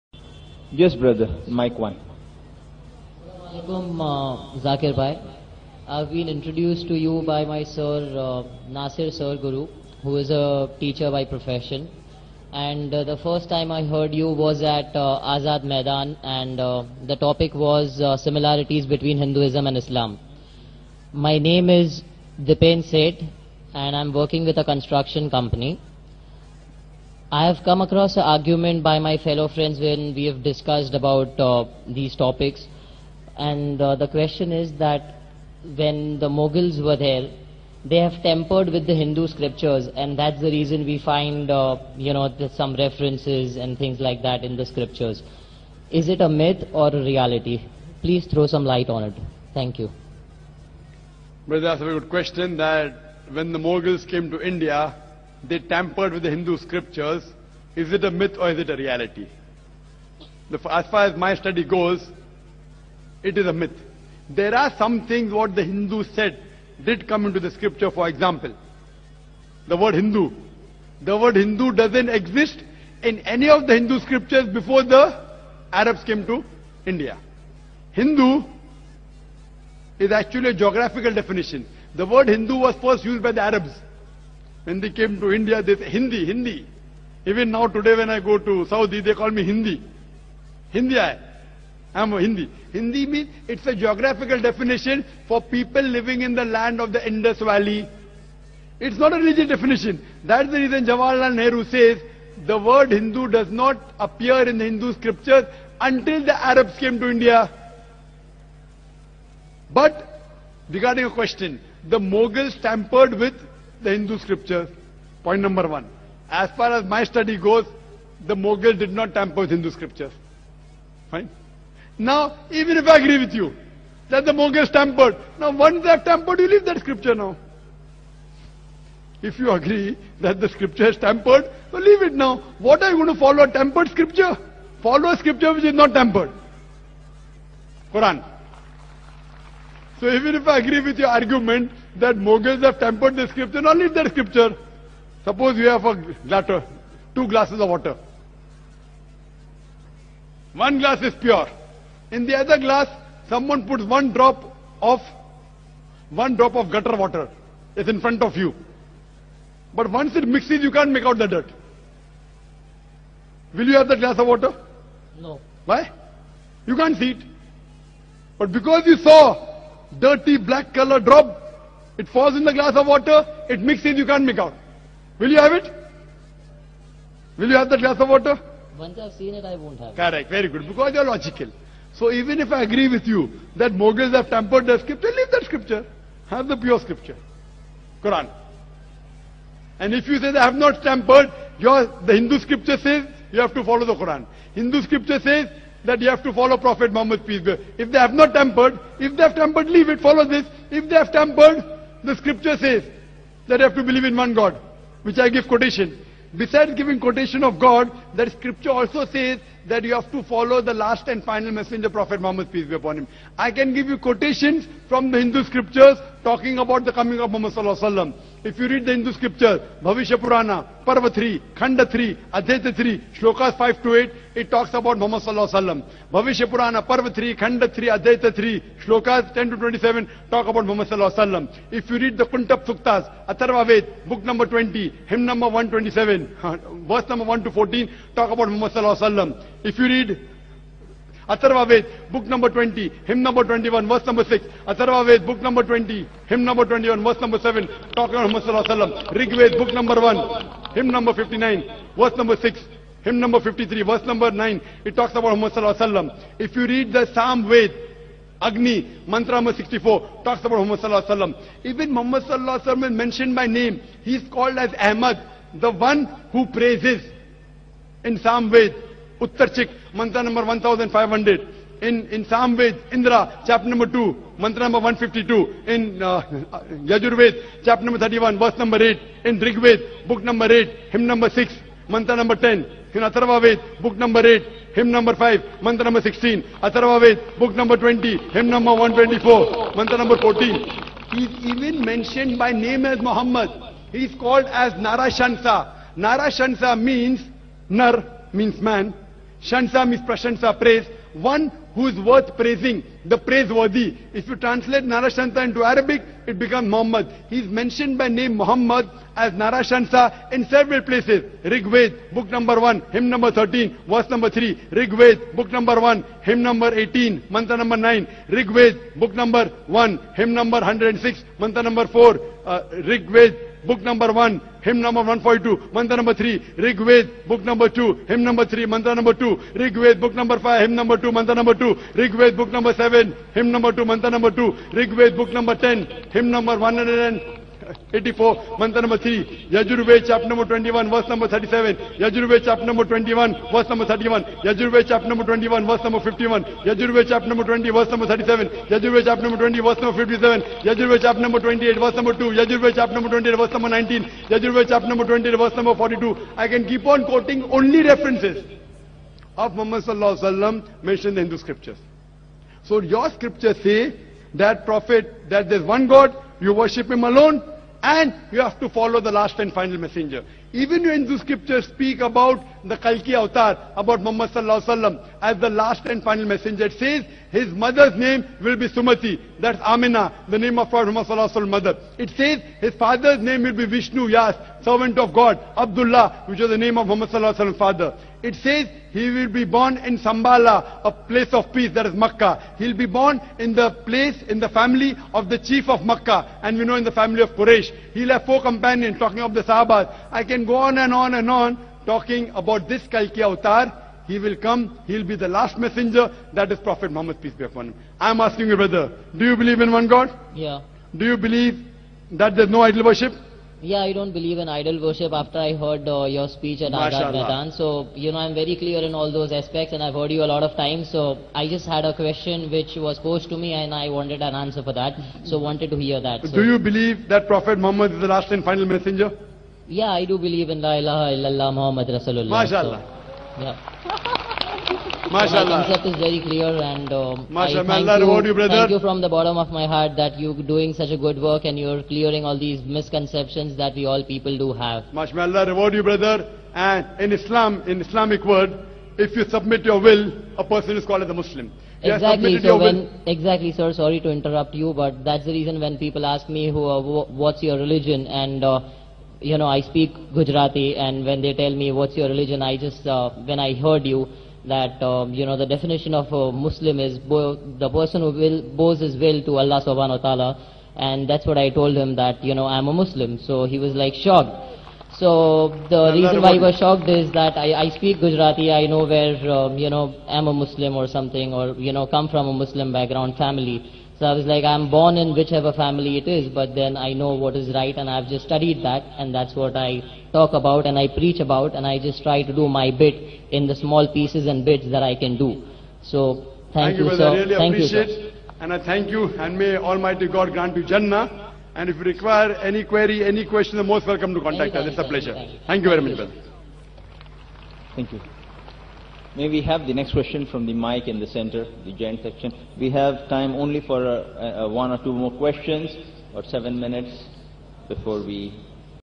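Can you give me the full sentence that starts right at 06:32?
He'll be born in the place, in the family of the chief of Makkah.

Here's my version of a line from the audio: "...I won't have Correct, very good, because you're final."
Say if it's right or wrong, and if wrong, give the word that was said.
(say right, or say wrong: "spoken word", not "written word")
wrong: "logical", not "final".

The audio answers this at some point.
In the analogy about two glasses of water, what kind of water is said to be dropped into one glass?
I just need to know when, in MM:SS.
02:36.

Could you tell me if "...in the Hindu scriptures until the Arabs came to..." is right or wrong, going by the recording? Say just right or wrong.
right.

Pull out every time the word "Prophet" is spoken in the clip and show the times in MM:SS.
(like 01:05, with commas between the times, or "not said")
03:16, 03:31, 06:20, 06:46, 07:07.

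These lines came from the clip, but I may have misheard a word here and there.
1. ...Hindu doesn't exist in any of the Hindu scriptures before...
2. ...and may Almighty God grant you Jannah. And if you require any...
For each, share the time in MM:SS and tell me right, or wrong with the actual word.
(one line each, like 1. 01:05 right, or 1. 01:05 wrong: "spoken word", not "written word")
1. 01:11 right
2. 08:19 right.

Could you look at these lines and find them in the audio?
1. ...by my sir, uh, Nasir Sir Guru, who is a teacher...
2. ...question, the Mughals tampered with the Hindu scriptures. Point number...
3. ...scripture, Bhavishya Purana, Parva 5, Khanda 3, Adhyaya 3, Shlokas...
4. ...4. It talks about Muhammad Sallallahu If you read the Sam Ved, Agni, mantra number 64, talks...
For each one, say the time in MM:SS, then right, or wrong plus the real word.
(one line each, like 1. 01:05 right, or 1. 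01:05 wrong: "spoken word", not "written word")
1. 00:07 right
2. 01:51 right
3. 03:39 wrong: "3", not "5"
4. 04:14 wrong: "9", not "4".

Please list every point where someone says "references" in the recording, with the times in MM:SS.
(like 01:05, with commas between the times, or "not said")
00:42.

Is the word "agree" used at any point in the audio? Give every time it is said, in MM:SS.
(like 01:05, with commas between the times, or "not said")
02:02, 02:09, 02:20, 03:02.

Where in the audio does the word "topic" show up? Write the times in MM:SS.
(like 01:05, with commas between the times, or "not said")
00:17, 00:32.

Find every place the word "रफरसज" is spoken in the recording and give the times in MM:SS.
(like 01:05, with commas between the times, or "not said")
05:57.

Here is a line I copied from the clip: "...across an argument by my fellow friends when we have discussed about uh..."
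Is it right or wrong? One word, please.
right.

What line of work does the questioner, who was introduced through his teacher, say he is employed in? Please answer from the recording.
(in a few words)
Construction company.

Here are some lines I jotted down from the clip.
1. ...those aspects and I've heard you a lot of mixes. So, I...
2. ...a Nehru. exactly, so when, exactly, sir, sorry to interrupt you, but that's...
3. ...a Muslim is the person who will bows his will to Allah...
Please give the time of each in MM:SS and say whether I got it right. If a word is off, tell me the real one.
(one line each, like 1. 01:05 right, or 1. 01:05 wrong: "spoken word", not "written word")
1. 06:59 wrong: "times", not "mixes"
2. 07:31 wrong: "Muslim", not "Nehru"
3. 07:46 right.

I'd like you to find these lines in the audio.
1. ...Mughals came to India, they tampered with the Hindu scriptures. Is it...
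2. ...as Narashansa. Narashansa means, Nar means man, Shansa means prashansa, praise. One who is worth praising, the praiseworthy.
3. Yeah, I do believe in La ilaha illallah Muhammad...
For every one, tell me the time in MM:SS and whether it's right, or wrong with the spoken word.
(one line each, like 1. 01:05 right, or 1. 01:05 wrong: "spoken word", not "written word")
1. 00:53 right
2. 04:54 right
3. 07:09 right.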